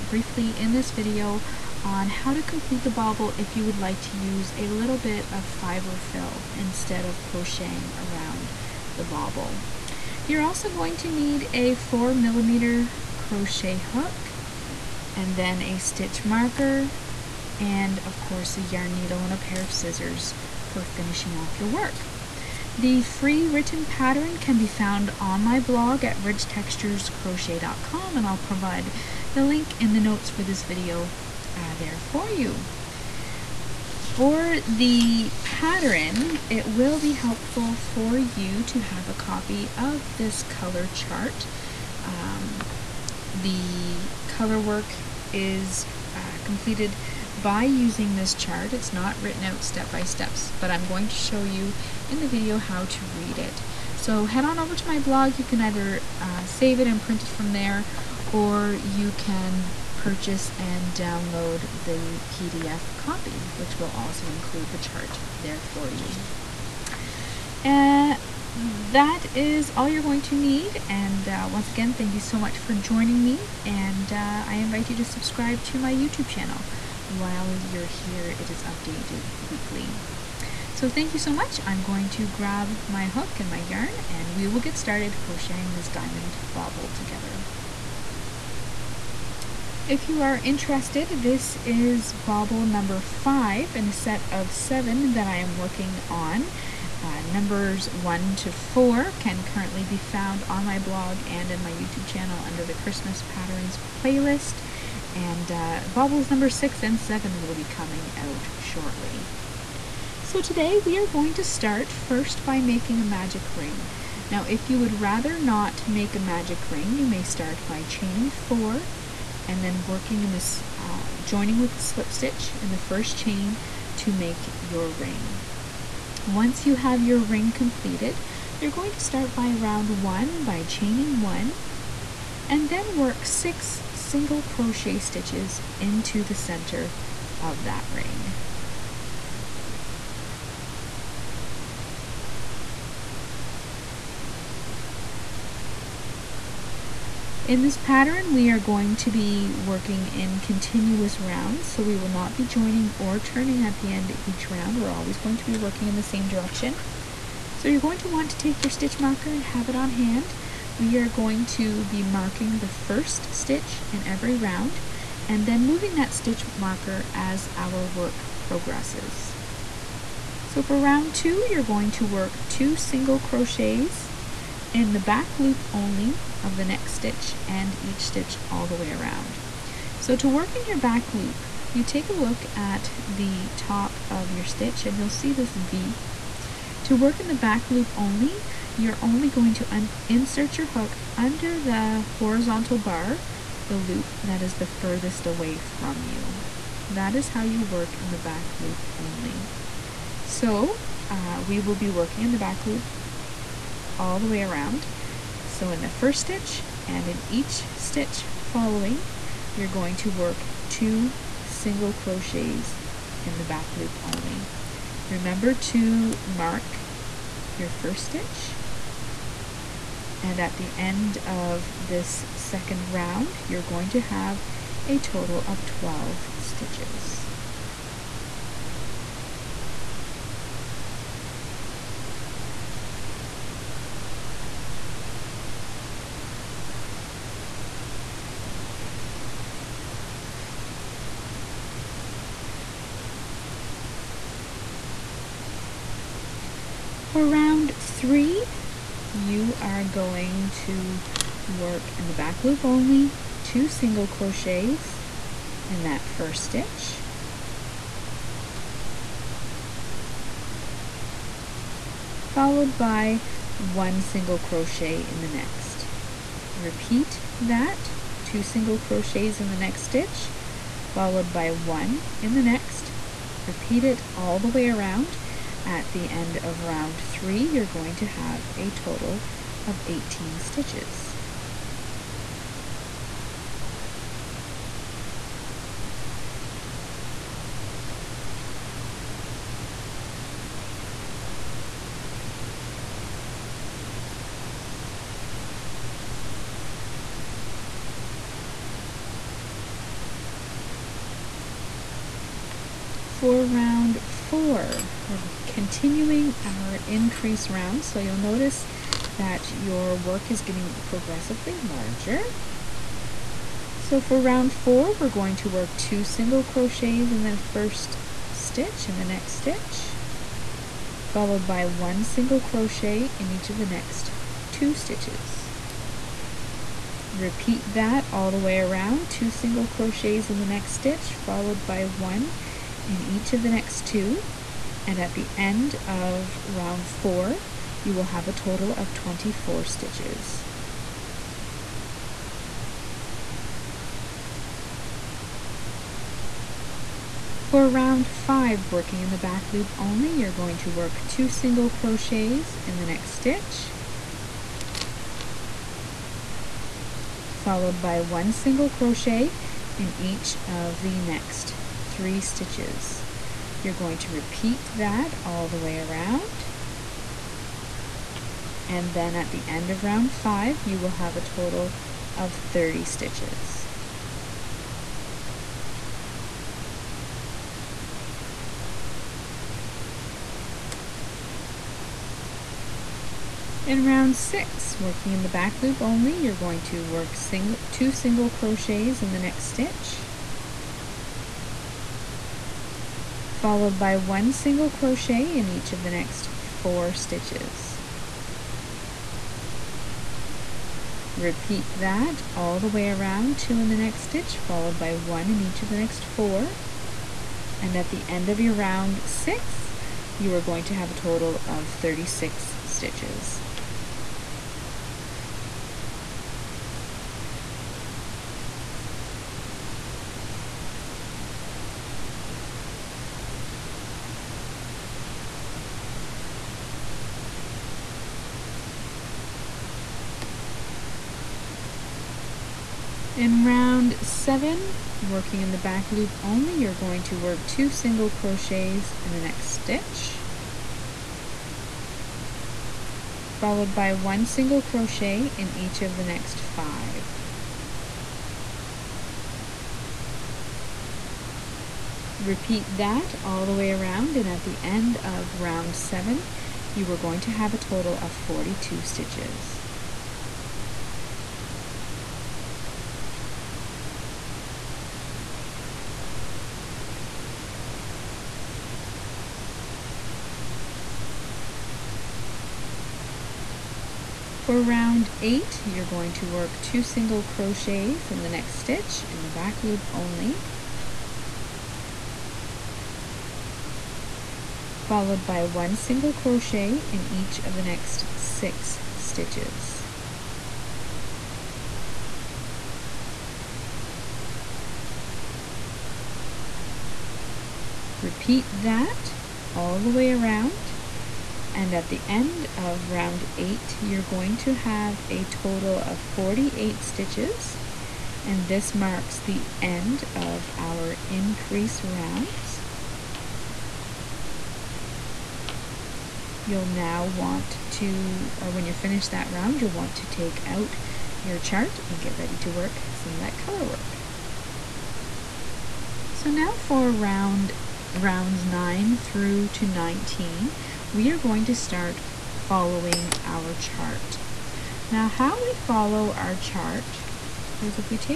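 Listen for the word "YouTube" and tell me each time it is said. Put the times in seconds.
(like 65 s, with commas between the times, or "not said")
75 s, 101 s.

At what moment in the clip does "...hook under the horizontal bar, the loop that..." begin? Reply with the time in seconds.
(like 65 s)
190 s.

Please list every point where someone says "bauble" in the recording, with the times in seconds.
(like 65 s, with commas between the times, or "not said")
2 s, 9 s.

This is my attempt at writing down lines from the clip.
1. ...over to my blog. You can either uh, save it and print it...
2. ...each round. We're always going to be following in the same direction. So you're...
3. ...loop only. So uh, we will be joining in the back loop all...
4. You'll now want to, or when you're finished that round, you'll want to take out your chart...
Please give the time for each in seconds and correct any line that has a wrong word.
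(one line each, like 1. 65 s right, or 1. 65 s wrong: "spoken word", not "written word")
1. 54 s right
2. 154 s wrong: "working", not "following"
3. 198 s wrong: "working", not "joining"
4. 516 s right.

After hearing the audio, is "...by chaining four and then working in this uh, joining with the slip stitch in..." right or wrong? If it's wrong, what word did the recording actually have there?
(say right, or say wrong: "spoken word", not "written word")
right.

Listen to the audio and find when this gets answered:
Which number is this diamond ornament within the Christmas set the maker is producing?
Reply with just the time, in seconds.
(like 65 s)
92 s.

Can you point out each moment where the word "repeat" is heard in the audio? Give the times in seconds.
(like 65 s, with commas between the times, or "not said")
266 s, 273 s, 327 s, 364 s, 401 s, 452 s, 497 s.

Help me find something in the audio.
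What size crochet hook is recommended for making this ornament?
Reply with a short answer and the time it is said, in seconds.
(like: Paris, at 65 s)
4 millimeter, at 11 s.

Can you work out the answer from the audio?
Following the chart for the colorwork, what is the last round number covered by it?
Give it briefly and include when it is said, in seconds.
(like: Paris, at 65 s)
19, at 529 s.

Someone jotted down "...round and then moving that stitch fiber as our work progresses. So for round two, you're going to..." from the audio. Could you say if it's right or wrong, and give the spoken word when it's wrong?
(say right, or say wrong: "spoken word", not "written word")
wrong: "marker", not "fiber".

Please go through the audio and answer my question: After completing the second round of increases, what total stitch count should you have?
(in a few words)
12.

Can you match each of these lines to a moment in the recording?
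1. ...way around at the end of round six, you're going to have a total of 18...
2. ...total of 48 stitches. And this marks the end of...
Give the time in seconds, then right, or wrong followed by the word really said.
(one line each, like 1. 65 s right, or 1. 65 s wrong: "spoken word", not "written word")
1. 274 s wrong: "three", not "six"
2. 505 s right.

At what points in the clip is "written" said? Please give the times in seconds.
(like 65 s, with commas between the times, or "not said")
23 s, 49 s.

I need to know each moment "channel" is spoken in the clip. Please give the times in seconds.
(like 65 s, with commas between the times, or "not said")
76 s, 102 s.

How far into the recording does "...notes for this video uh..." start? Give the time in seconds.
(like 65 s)
30 s.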